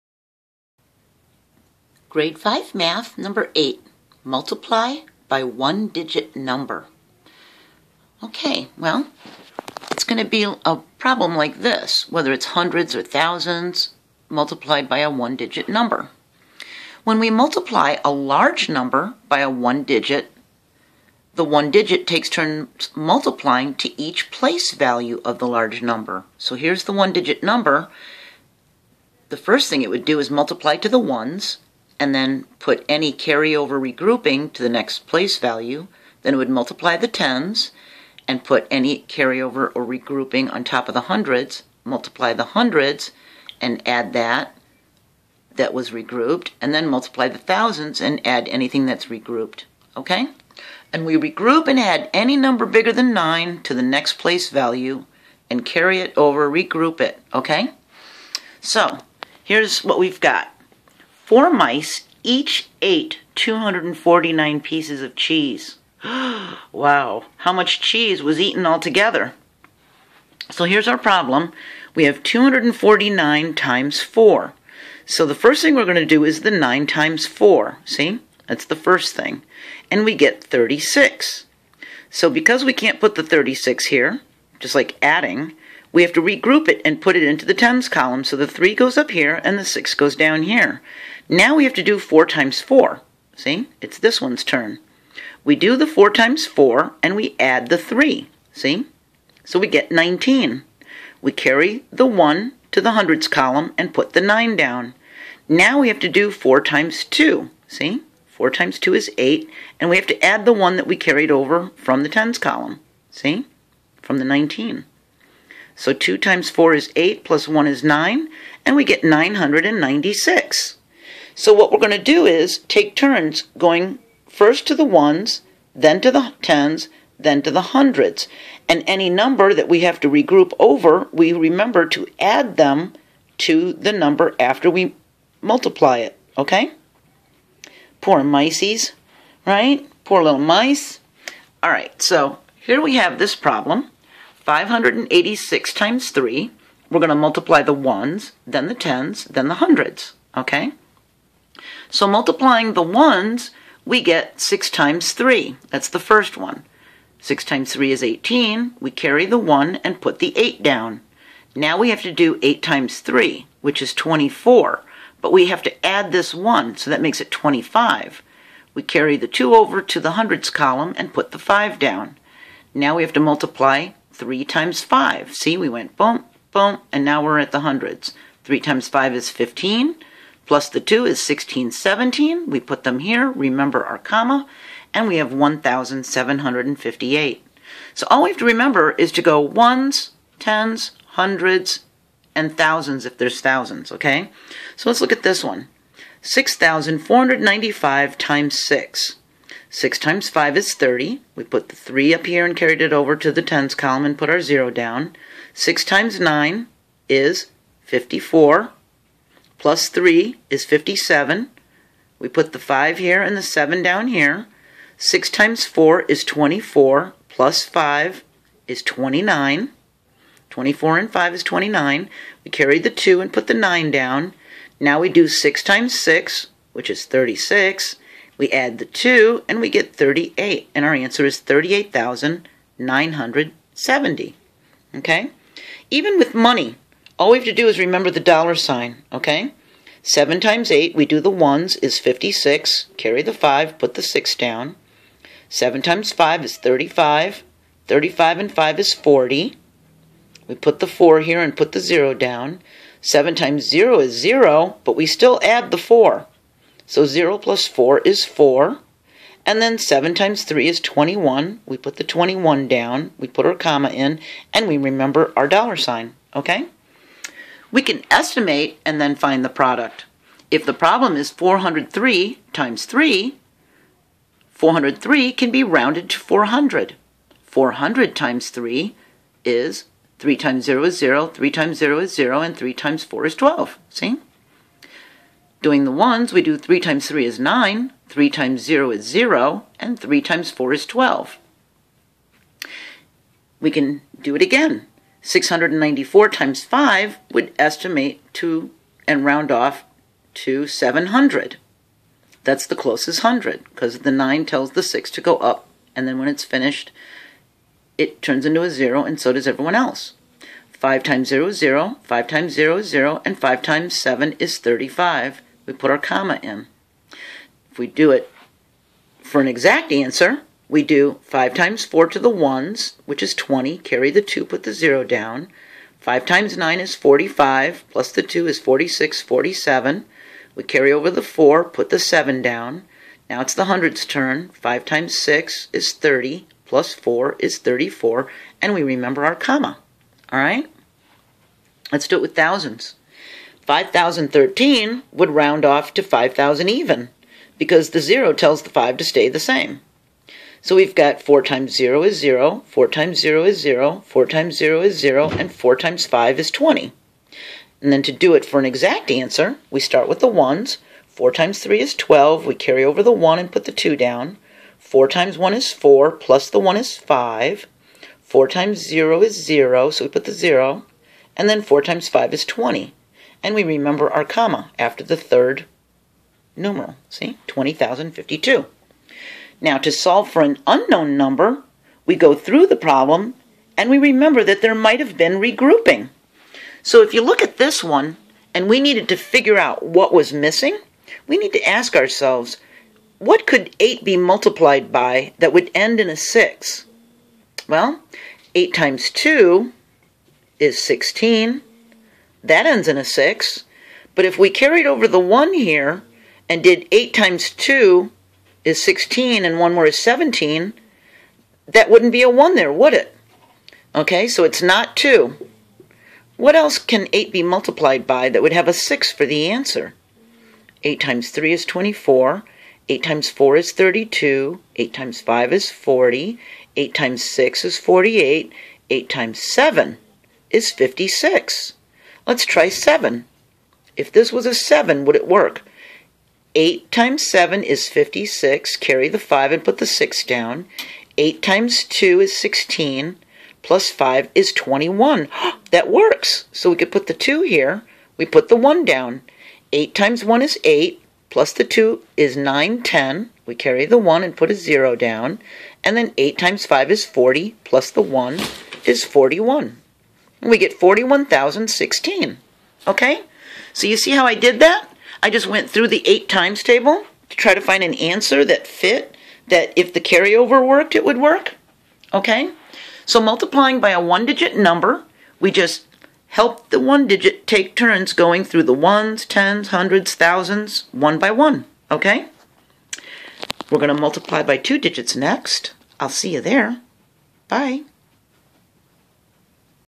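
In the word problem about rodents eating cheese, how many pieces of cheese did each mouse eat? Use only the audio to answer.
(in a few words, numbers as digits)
249.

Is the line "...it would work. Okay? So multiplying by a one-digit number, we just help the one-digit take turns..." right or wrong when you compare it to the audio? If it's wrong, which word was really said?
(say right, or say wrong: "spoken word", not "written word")
right.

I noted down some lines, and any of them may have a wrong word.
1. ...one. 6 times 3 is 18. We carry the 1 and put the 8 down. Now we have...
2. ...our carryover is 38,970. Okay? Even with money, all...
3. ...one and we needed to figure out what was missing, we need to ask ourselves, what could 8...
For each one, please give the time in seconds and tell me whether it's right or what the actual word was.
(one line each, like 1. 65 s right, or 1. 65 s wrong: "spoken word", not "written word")
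1. 156 s right
2. 230 s wrong: "answer", not "carryover"
3. 387 s right.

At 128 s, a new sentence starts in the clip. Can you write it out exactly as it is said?
And any number that we have to regroup over, we remember to add them to the number after we multiply it, okay?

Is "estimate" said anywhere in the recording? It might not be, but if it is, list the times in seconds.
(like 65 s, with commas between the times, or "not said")
268 s, 297 s.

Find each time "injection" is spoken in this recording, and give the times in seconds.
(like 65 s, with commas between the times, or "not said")
not said.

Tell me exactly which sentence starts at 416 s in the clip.
What else can 8 be multiplied by that would have a 6 for the answer?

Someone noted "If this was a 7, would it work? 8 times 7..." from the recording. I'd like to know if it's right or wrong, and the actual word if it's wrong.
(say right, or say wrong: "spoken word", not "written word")
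right.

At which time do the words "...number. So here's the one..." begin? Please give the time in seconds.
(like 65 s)
25 s.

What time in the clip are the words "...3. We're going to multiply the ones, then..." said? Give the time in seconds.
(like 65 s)
146 s.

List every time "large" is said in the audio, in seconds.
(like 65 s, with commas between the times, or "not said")
18 s, 25 s.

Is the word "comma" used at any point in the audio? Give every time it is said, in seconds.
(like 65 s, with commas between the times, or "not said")
183 s, 263 s, 315 s, 339 s, 374 s.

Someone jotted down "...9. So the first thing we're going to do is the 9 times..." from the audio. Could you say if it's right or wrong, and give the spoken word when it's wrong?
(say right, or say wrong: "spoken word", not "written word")
wrong: "4", not "9".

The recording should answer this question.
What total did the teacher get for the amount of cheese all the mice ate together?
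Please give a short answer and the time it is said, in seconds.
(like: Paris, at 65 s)
996, at 119 s.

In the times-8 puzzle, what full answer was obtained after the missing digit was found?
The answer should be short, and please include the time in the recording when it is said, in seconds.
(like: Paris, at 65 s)
41,016, at 460 s.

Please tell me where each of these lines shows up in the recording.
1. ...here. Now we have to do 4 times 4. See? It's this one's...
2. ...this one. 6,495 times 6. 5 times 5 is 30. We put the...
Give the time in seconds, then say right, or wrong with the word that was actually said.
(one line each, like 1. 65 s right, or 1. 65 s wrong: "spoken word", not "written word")
1. 90 s right
2. 195 s wrong: "6", not "5".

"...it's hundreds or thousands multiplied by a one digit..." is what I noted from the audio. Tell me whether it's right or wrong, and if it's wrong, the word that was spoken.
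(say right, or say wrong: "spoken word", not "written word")
right.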